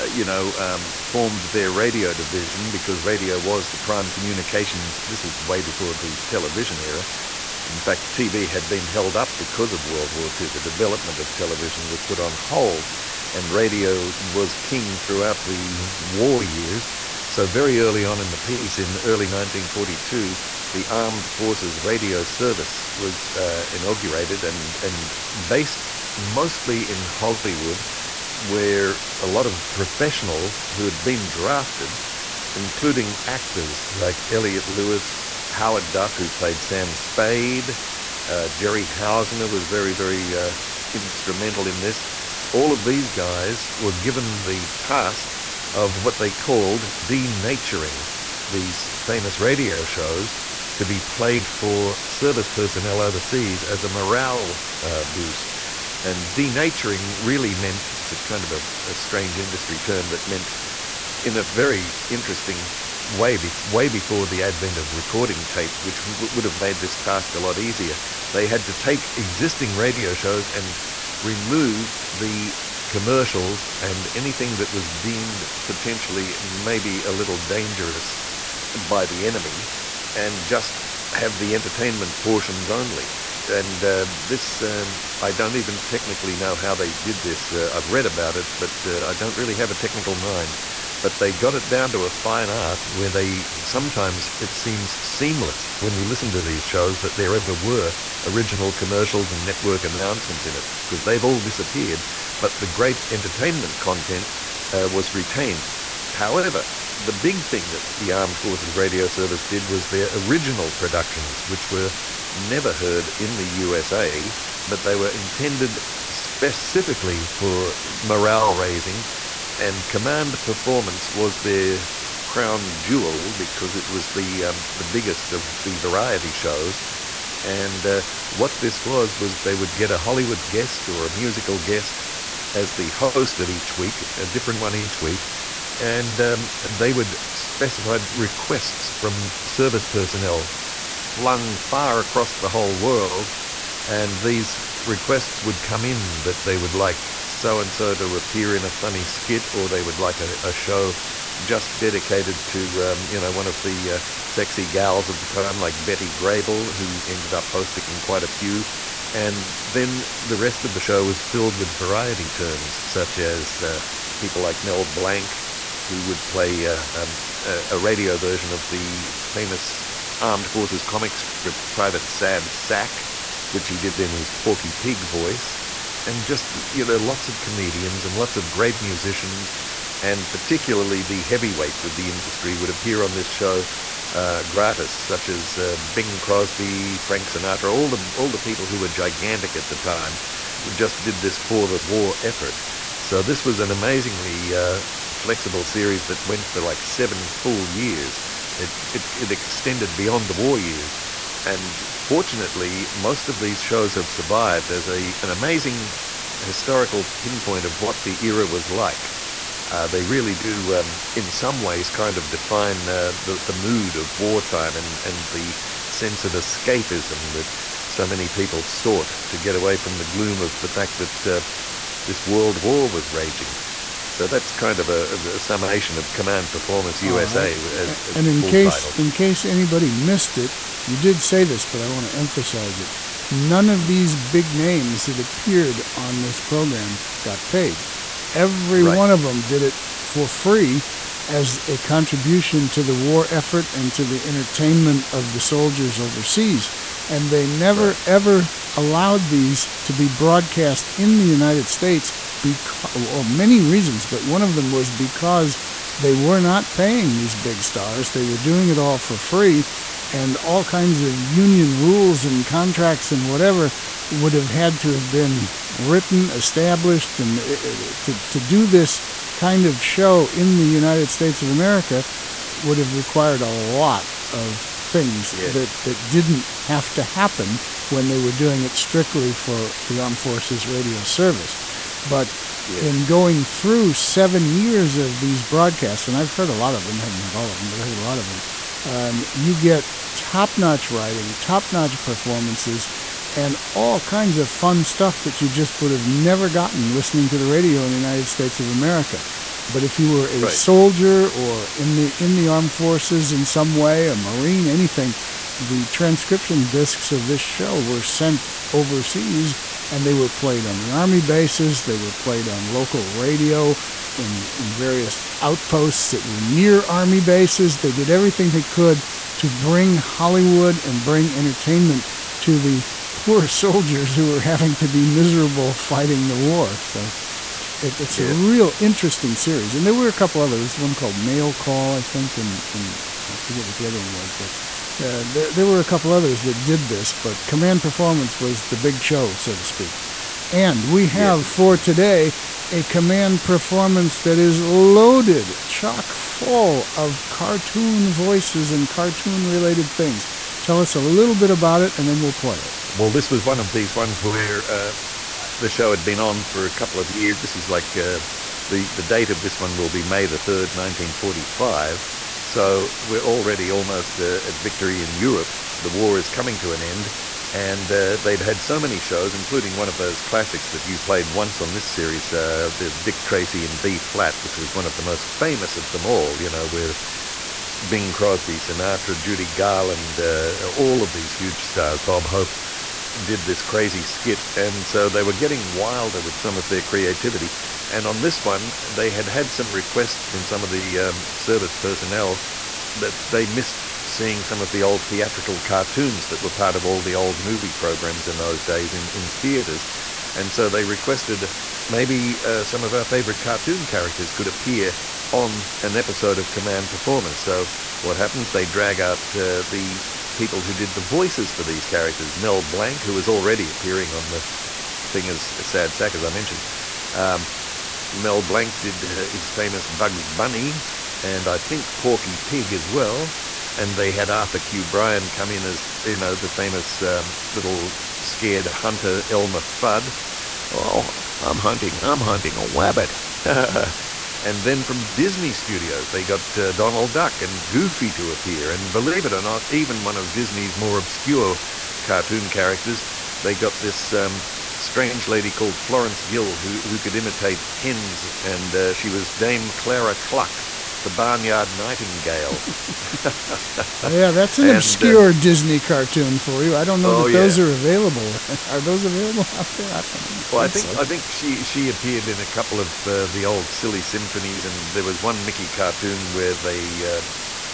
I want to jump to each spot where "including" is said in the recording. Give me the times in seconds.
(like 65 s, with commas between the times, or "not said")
32 s, 369 s.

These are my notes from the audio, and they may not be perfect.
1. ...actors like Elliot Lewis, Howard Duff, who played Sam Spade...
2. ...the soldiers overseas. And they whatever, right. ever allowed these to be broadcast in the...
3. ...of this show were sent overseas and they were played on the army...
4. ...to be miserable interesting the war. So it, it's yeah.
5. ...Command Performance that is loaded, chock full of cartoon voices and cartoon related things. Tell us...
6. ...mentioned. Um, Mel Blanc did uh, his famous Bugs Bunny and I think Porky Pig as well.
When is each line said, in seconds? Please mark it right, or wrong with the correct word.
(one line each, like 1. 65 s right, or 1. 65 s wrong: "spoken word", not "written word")
1. 33 s right
2. 245 s wrong: "never", not "whatever"
3. 307 s right
4. 324 s wrong: "fighting", not "interesting"
5. 342 s right
6. 416 s right.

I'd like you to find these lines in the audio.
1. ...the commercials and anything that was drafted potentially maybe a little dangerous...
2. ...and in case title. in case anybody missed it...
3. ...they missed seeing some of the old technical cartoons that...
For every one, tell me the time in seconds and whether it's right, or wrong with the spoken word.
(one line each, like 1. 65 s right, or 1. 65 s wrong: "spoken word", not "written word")
1. 72 s wrong: "deemed", not "drafted"
2. 228 s right
3. 393 s wrong: "theatrical", not "technical".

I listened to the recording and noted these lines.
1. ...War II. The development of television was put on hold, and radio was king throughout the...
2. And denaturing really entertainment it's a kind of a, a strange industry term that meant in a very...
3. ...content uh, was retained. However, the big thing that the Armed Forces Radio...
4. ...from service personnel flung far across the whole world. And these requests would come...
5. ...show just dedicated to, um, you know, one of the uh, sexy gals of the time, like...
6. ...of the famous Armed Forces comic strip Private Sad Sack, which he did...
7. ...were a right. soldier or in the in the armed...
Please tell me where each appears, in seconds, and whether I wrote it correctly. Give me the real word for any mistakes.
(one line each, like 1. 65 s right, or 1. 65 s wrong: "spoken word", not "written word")
1. 10 s right
2. 56 s wrong: "meant", not "entertainment"
3. 103 s right
4. 138 s right
5. 150 s right
6. 168 s right
7. 300 s right.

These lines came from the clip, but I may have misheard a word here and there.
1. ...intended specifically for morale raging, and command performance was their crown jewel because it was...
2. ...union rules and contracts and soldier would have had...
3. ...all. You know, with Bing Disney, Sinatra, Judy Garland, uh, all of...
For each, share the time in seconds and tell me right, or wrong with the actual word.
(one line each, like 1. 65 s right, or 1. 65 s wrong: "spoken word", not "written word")
1. 115 s wrong: "raising", not "raging"
2. 261 s wrong: "whatever", not "soldier"
3. 376 s wrong: "Crosby", not "Disney".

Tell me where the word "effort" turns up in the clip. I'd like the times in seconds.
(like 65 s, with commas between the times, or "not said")
192 s, 243 s.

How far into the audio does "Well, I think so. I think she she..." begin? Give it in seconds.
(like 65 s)
460 s.